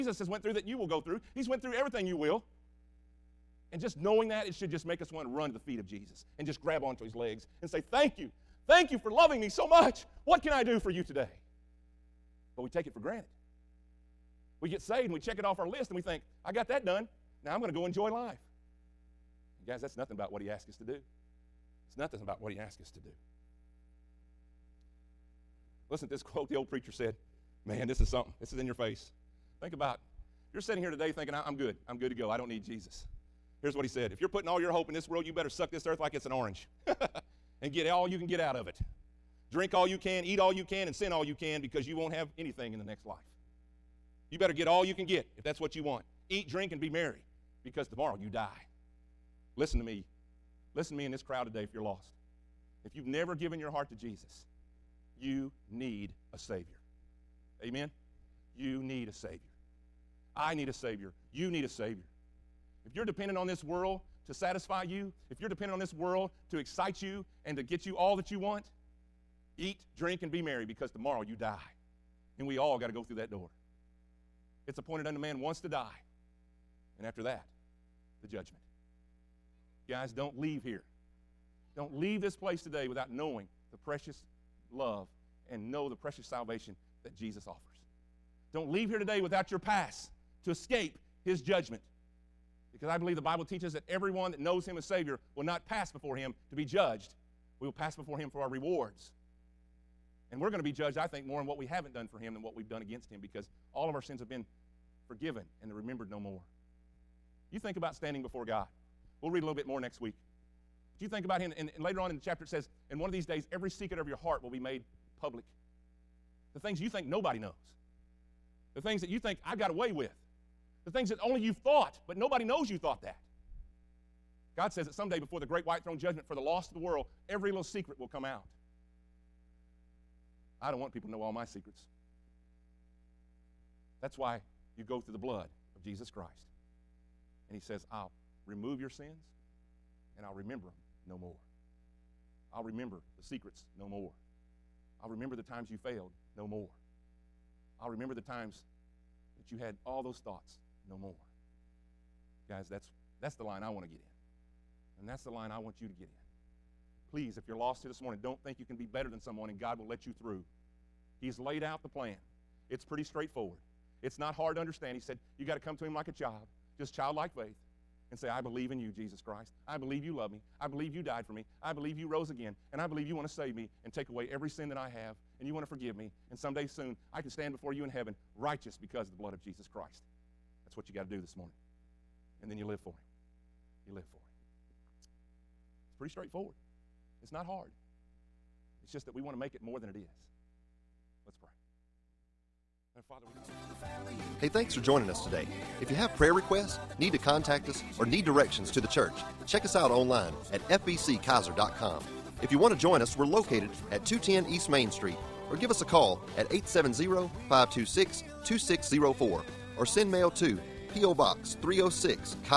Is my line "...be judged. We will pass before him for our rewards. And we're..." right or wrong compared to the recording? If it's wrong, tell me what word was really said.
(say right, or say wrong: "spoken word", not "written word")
right.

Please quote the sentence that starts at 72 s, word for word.
And we all got to go through that door.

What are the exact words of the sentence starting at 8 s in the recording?
Thank you for loving me so much.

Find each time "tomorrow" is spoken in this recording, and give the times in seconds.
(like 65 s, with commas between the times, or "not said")
47 s, 70 s.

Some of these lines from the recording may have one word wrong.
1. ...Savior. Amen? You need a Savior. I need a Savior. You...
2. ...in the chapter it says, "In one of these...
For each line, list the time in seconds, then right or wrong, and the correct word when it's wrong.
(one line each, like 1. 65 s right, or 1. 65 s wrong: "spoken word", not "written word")
1. 56 s right
2. 112 s right.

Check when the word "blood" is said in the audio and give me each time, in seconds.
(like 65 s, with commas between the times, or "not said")
135 s, 179 s.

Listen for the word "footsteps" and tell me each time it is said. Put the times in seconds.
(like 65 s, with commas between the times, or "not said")
not said.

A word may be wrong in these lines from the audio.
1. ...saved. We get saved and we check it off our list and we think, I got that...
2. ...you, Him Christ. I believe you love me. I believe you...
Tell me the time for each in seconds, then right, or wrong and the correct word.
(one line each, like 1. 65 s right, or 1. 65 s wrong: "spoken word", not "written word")
1. 12 s wrong: "granted", not "saved"
2. 168 s wrong: "Jesus", not "Him".